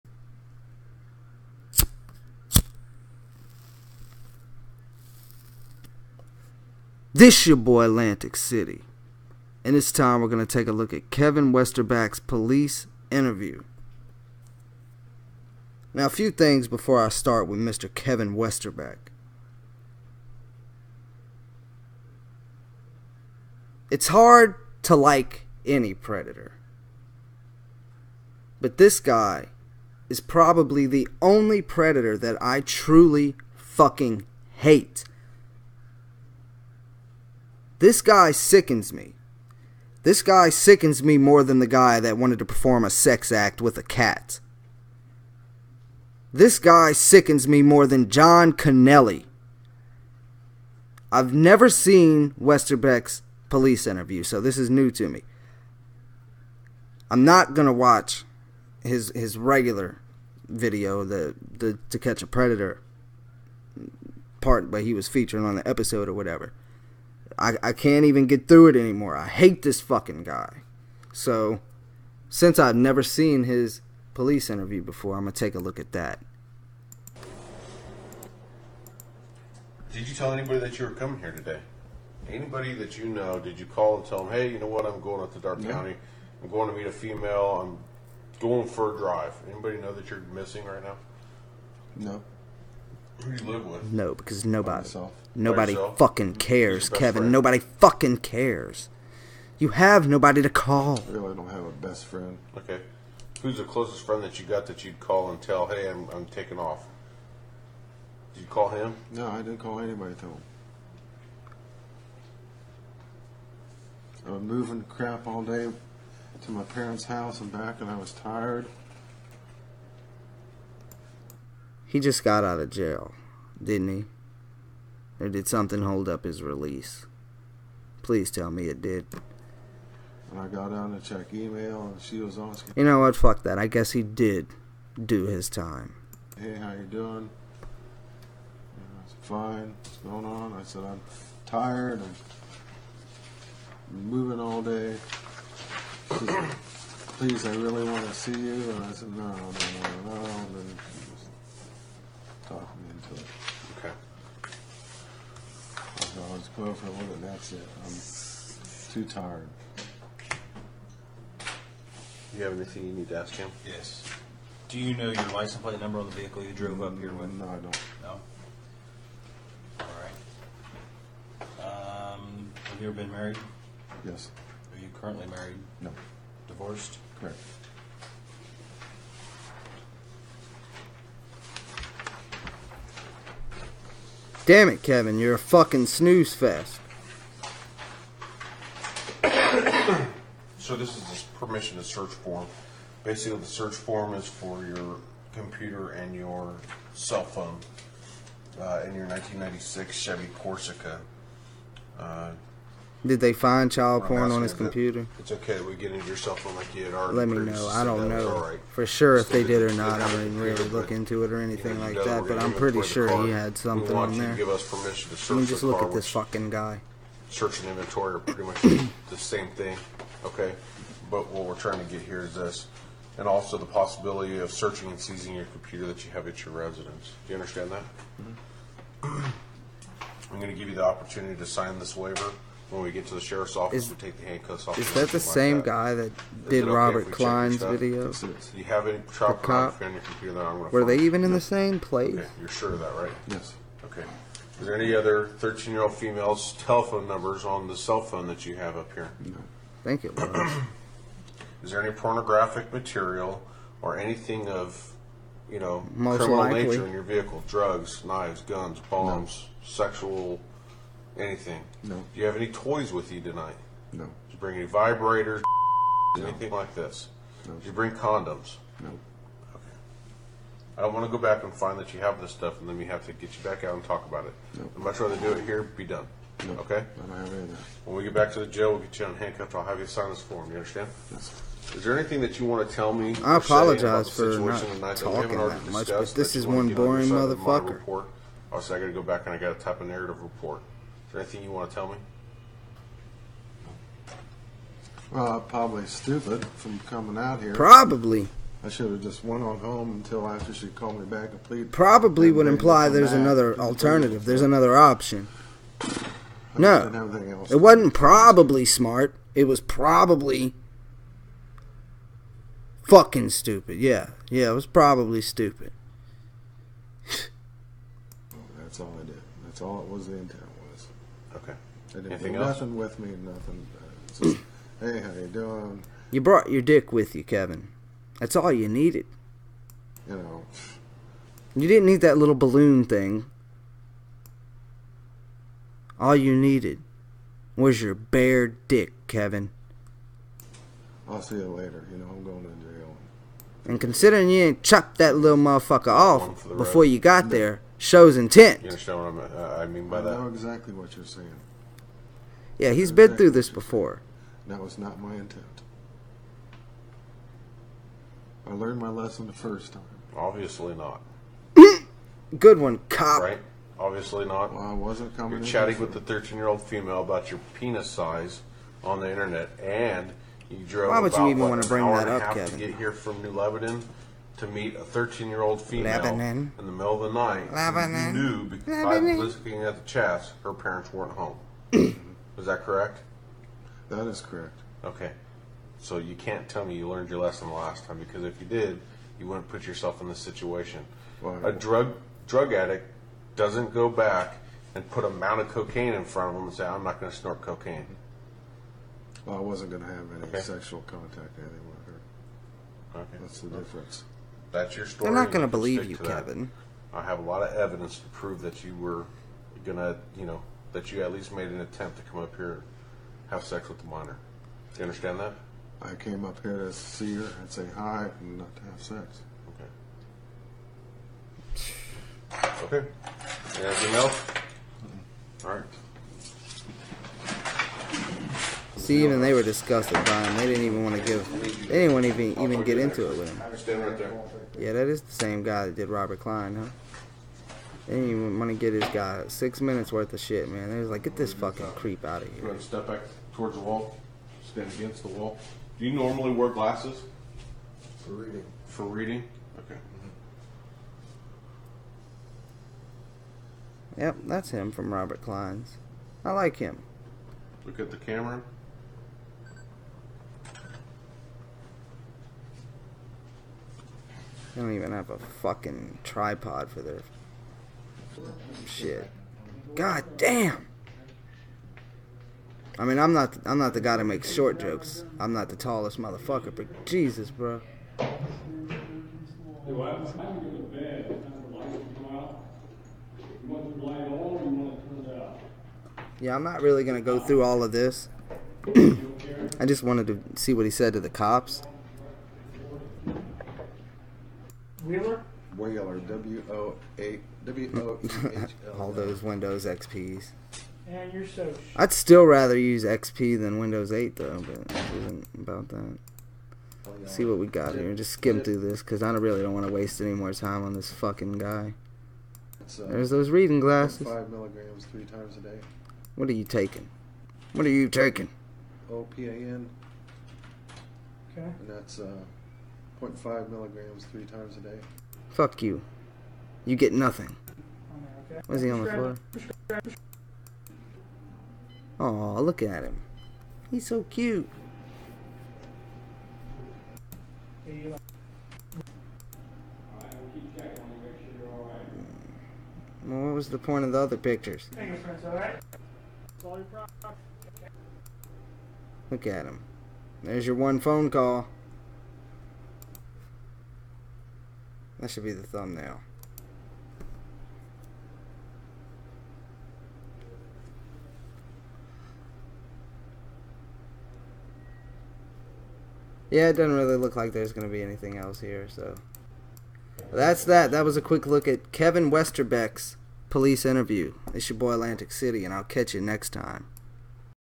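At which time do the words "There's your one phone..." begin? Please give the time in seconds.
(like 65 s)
550 s.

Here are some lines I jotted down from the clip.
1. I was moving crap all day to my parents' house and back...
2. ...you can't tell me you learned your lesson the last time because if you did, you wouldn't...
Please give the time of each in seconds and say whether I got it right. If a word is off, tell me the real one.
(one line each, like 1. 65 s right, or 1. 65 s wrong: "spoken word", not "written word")
1. 114 s right
2. 385 s right.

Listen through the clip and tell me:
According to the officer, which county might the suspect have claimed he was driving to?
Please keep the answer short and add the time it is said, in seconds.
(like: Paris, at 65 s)
Darke County, at 85 s.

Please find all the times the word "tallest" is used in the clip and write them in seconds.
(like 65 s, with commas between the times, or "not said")
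475 s.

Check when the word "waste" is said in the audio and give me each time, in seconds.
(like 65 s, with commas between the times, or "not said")
509 s.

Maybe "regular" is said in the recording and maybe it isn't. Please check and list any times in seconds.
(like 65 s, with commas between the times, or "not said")
59 s.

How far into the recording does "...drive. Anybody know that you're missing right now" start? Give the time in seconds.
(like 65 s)
88 s.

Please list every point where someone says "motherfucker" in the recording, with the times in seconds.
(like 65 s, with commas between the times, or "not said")
287 s, 345 s, 475 s.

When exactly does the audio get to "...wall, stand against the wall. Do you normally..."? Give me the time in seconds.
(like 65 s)
443 s.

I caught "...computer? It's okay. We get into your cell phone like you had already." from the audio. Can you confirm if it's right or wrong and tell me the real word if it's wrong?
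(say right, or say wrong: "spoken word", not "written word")
right.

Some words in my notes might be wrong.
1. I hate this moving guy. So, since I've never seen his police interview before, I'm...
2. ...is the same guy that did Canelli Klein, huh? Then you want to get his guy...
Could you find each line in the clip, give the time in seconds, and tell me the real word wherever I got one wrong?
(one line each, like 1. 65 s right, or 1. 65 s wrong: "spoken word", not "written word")
1. 69 s wrong: "fucking", not "moving"
2. 434 s wrong: "Robert", not "Canelli".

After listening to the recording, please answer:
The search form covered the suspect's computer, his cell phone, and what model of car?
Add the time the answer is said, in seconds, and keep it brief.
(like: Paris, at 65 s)
Chevy Corsica, at 199 s.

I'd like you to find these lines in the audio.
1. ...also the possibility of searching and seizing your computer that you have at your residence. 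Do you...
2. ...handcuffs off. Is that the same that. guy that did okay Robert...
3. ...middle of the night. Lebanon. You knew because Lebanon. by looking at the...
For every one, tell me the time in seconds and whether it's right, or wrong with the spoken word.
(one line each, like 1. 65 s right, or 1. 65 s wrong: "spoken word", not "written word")
1. 223 s right
2. 234 s right
3. 376 s right.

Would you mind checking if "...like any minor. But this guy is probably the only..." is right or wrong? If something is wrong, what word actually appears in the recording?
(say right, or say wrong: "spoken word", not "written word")
wrong: "predator", not "minor".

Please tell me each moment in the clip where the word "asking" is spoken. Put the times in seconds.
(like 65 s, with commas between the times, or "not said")
132 s.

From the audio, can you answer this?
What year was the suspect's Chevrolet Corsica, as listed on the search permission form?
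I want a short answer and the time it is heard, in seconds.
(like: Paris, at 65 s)
1996, at 199 s.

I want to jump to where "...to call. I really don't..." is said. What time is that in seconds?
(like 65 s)
100 s.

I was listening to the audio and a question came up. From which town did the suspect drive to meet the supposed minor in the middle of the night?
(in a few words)
New Lebanon.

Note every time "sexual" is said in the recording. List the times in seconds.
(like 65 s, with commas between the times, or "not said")
259 s, 400 s.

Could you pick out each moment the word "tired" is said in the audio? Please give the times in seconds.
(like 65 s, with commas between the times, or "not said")
118 s, 141 s, 159 s.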